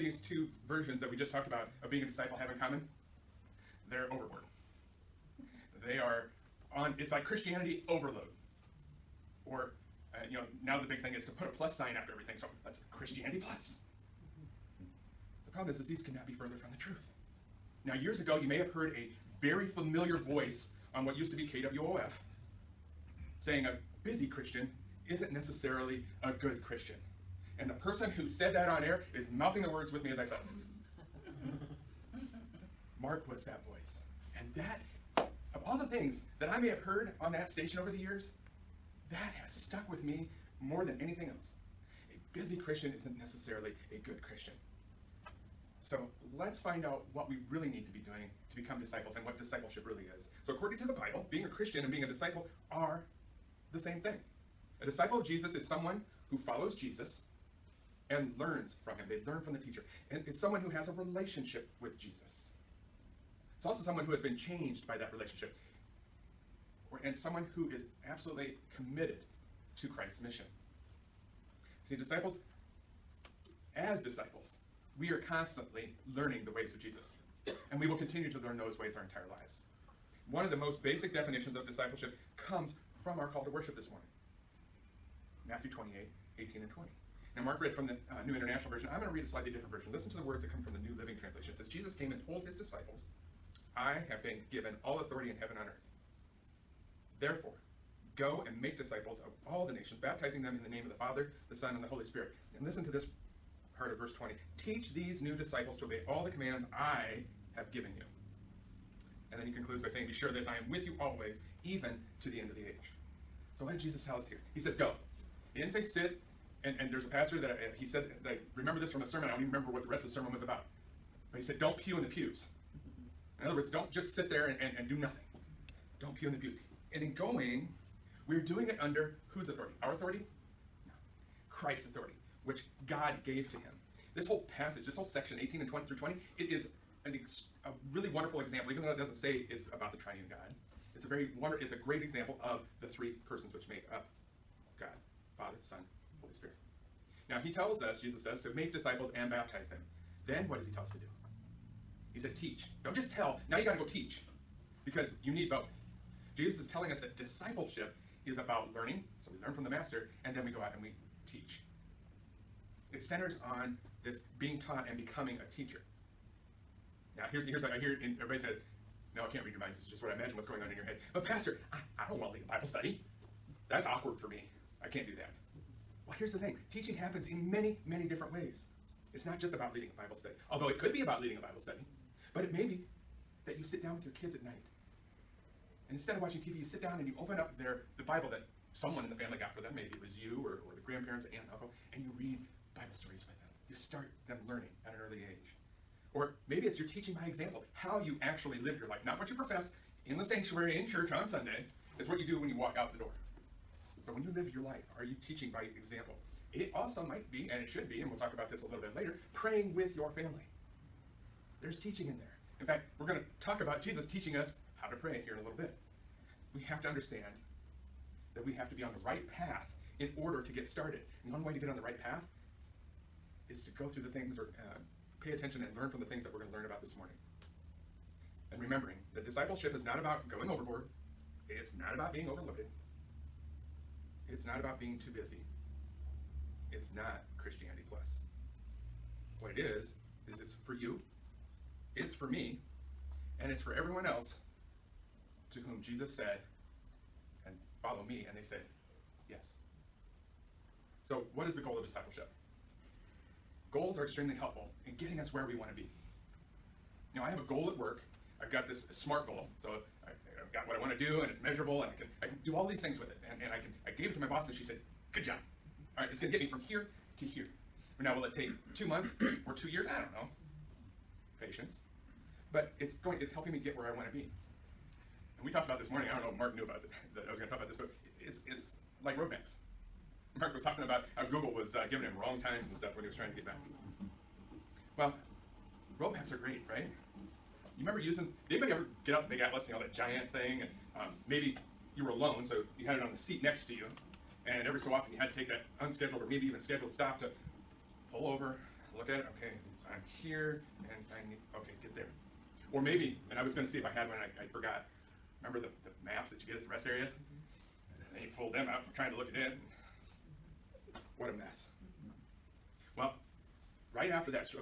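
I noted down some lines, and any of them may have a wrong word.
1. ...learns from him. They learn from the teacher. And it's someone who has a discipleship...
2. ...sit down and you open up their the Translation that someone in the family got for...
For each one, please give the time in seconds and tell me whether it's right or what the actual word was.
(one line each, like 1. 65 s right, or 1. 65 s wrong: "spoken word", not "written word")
1. 58 s wrong: "relationship", not "discipleship"
2. 186 s wrong: "Bible", not "Translation".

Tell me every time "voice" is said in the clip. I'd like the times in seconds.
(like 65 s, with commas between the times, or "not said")
20 s, 33 s.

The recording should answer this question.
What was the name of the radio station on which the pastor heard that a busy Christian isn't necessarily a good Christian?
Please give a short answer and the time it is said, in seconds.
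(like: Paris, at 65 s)
KWOF, at 21 s.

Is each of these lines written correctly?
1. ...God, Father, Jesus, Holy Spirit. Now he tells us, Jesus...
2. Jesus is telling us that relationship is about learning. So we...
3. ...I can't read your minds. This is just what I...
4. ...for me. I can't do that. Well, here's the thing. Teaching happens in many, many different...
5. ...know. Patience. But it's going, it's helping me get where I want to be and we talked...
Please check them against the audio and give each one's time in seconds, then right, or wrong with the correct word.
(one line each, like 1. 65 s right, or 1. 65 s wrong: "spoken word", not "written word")
1. 144 s wrong: "Son", not "Jesus"
2. 156 s wrong: "discipleship", not "relationship"
3. 169 s right
4. 174 s right
5. 270 s right.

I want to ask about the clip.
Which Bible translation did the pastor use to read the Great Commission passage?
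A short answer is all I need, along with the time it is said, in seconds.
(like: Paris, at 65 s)
New Living Translation, at 90 s.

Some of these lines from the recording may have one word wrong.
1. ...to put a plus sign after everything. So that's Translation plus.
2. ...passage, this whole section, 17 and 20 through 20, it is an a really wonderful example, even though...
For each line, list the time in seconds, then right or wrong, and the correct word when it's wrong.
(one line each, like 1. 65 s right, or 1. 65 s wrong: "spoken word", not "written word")
1. 11 s wrong: "Christianity", not "Translation"
2. 134 s wrong: "18", not "17".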